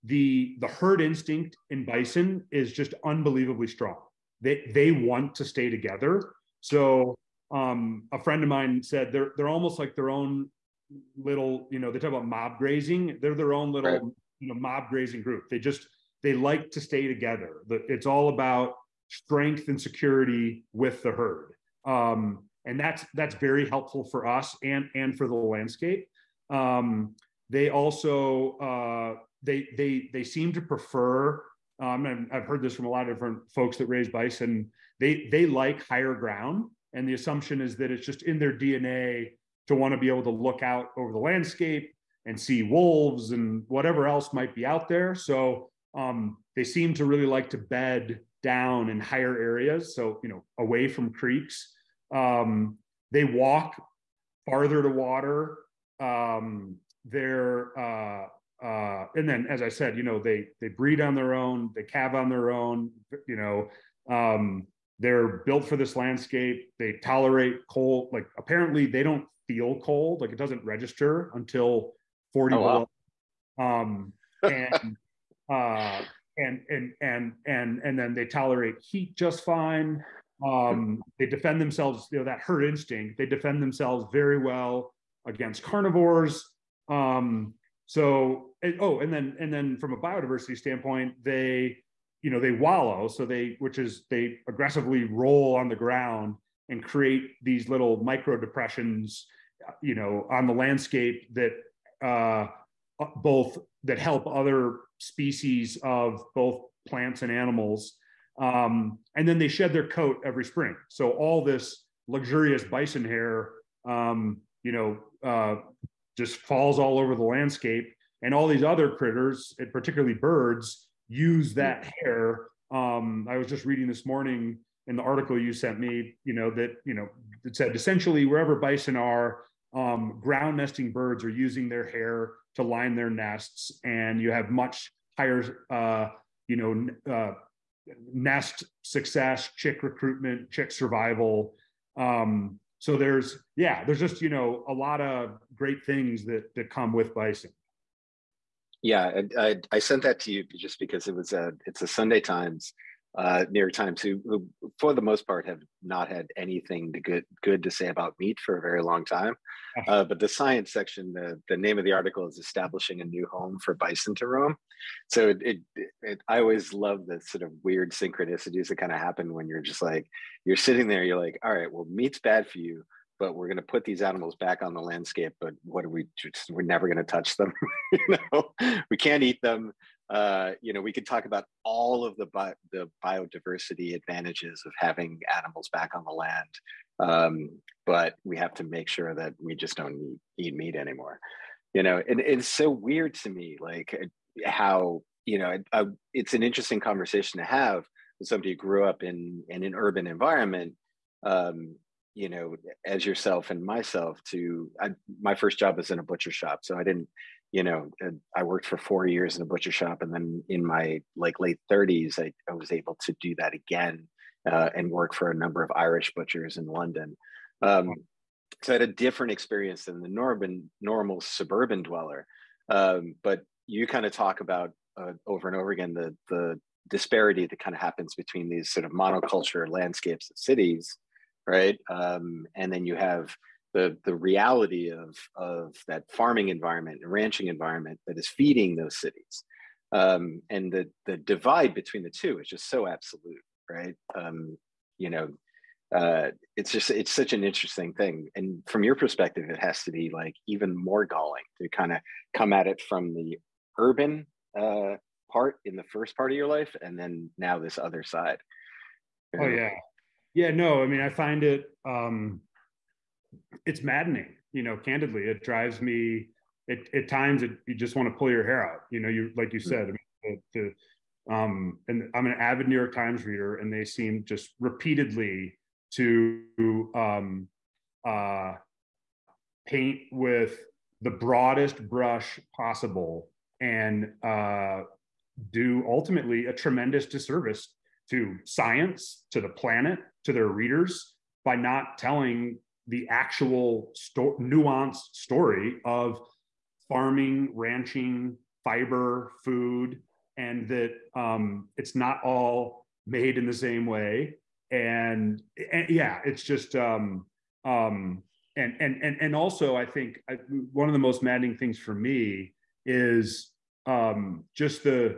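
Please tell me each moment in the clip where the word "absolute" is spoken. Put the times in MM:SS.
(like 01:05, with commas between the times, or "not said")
04:02.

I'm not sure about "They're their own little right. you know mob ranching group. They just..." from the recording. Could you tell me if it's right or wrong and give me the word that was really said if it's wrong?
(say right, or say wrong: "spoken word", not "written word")
wrong: "grazing", not "ranching".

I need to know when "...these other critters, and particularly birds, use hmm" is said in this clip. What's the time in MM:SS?
01:58.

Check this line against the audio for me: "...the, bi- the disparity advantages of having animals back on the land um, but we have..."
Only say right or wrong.
wrong.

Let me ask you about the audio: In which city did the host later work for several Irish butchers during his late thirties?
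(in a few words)
London.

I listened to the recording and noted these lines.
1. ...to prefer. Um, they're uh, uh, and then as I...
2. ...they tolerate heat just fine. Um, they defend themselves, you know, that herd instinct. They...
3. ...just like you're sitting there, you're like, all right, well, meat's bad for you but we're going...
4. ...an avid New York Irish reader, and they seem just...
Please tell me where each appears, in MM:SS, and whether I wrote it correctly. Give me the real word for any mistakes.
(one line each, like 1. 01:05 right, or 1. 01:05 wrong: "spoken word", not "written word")
1. 00:54 wrong: "water", not "prefer"
2. 01:18 right
3. 02:49 right
4. 04:32 wrong: "Times", not "Irish".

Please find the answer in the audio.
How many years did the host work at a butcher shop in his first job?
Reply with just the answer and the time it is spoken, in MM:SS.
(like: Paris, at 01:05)
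4, at 03:28.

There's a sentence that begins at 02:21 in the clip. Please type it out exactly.
Um, so there's, yeah, there's just, you know, a lot of great things that, that come with bison.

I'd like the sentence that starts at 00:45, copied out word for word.
So um, they seem to really like to bed down in higher areas, so you know away from creeks.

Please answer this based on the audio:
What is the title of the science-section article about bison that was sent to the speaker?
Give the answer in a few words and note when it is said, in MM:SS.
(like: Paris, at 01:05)
Establishing a new home for bison to roam, at 02:42.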